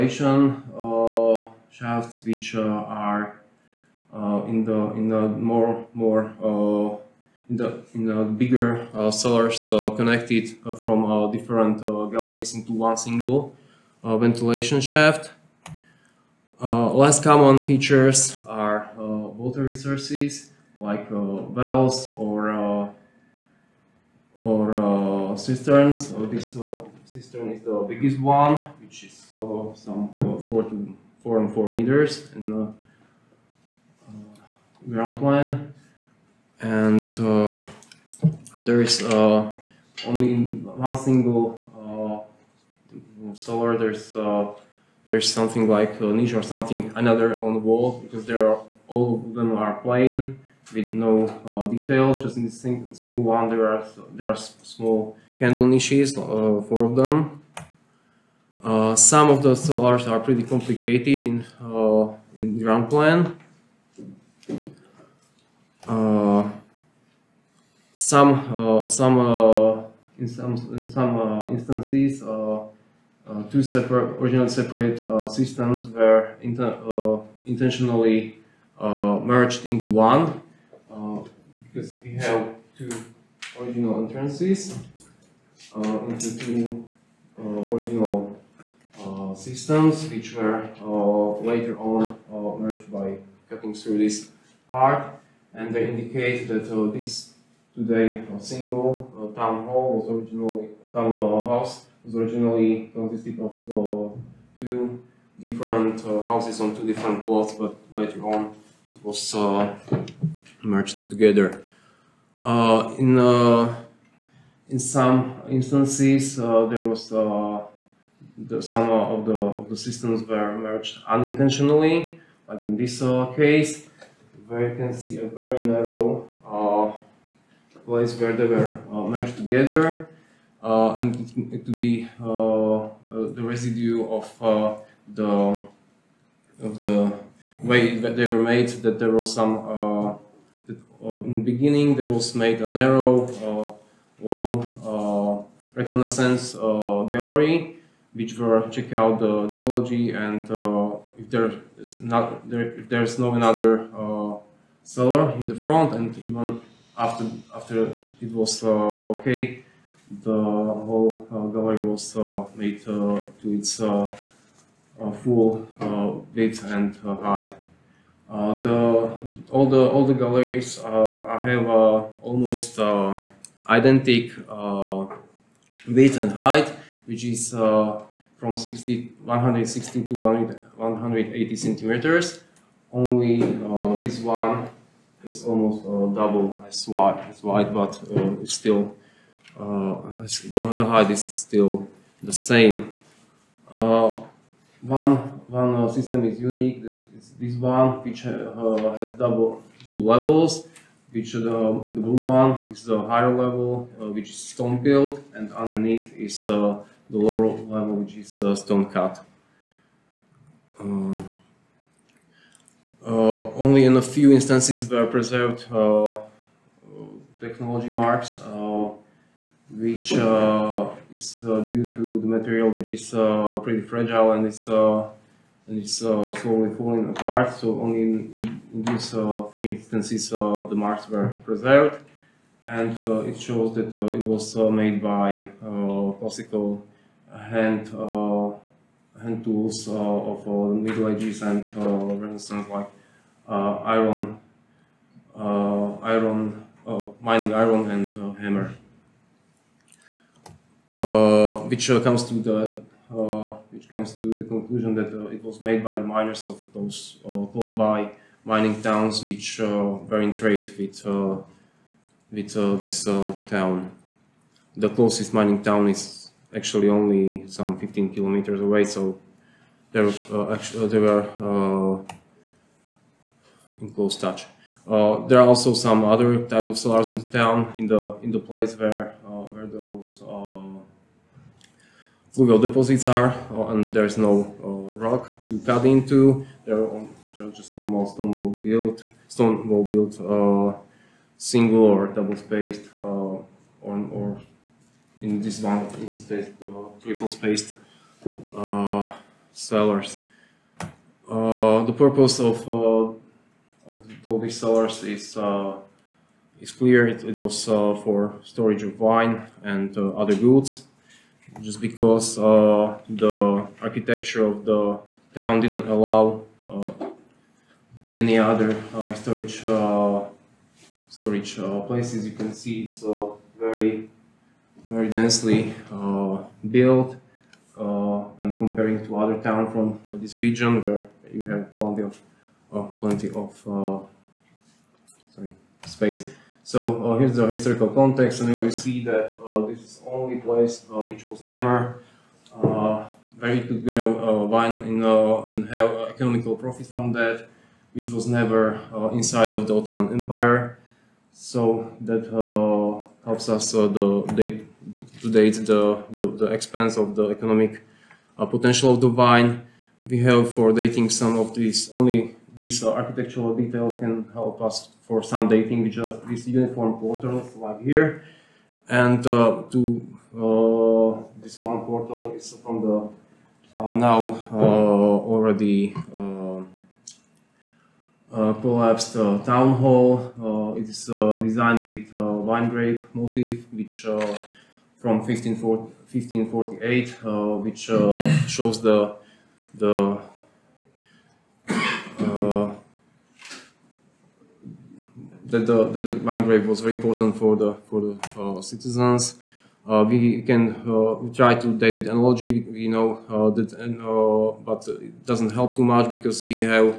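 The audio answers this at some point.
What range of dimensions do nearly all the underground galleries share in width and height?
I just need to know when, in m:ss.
2:58.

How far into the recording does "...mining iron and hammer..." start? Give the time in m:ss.
4:07.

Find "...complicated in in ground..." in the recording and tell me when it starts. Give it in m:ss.
1:00.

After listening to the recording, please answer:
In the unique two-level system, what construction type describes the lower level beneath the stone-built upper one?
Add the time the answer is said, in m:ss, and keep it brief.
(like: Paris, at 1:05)
stone cut, at 3:28.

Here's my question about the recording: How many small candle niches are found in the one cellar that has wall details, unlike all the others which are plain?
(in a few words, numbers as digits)
4.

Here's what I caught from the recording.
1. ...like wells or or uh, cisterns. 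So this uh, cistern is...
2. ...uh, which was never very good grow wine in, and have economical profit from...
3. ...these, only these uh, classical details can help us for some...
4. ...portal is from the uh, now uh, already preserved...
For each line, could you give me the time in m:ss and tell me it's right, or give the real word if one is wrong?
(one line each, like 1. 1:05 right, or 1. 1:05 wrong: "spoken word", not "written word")
1. 0:20 right
2. 5:40 right
3. 6:01 wrong: "architectural", not "classical"
4. 6:11 wrong: "collapsed", not "preserved".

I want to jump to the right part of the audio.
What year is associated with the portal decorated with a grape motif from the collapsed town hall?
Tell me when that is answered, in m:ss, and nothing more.
6:25.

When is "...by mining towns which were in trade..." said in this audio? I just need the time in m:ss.
4:17.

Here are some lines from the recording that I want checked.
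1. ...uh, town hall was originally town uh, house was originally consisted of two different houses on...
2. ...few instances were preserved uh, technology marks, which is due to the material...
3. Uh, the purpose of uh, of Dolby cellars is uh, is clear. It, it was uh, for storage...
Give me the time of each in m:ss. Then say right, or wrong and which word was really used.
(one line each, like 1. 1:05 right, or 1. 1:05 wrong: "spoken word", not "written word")
1. 1:39 right
2. 3:34 right
3. 5:01 right.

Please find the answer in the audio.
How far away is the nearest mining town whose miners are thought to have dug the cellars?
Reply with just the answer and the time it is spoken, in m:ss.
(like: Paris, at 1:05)
15 kilometers, at 4:27.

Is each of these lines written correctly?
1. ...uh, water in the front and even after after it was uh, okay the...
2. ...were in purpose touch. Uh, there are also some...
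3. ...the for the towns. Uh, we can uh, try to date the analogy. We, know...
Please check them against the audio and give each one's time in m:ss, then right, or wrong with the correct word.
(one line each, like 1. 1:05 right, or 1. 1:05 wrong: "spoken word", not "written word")
1. 2:33 wrong: "seller", not "water"
2. 4:30 wrong: "close", not "purpose"
3. 6:37 wrong: "citizens", not "towns".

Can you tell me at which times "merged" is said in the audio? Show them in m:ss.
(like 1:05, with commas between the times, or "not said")
1:19, 1:32, 1:50, 2:00, 2:09.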